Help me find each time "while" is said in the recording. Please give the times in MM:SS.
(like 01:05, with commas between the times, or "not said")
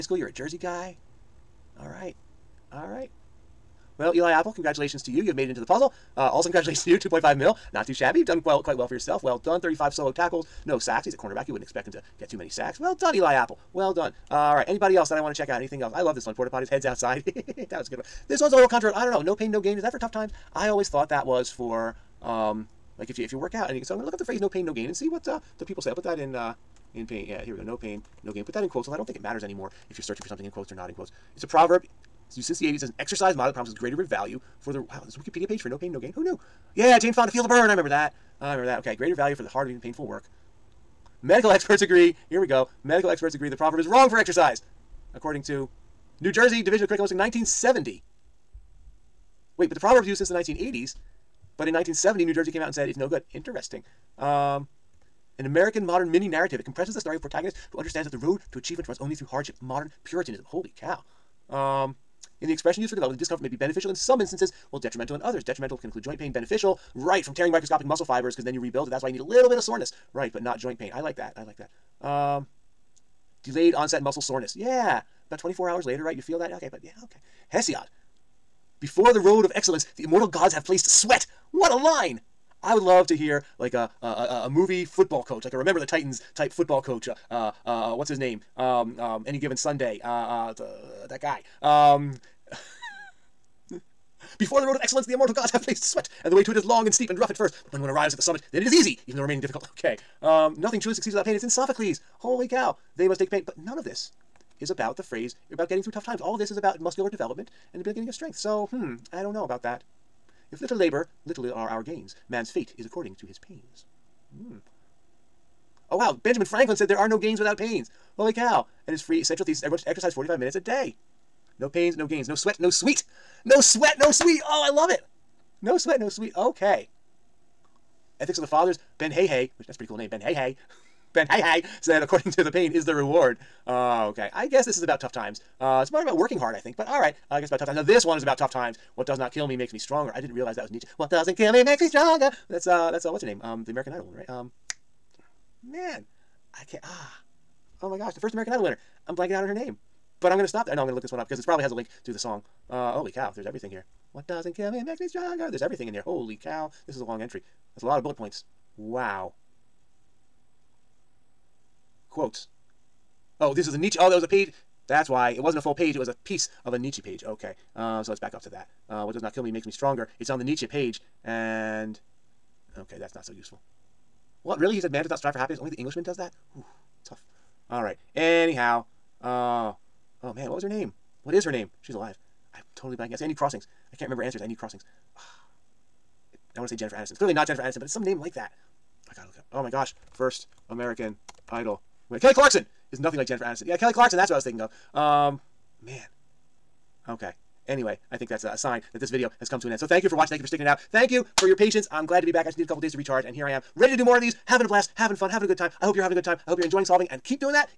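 01:04.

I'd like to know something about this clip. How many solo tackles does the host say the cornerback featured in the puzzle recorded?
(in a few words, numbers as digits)
35.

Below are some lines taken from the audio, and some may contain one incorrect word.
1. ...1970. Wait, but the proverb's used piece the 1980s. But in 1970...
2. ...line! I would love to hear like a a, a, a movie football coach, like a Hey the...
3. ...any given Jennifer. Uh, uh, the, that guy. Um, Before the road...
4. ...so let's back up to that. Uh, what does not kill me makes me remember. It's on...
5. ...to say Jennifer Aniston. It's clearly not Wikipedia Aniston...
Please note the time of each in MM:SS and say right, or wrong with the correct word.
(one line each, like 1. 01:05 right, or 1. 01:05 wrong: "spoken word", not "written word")
1. 00:47 wrong: "since", not "piece"
2. 01:21 wrong: "Remember", not "Hey"
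3. 01:29 wrong: "Sunday", not "Jennifer"
4. 02:48 wrong: "stronger", not "remember"
5. 03:06 wrong: "Jennifer", not "Wikipedia".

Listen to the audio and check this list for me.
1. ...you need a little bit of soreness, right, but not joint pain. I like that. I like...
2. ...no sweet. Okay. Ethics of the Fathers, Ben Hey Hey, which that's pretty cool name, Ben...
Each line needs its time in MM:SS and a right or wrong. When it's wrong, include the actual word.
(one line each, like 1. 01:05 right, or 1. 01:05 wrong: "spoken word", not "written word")
1. 01:09 right
2. 02:05 right.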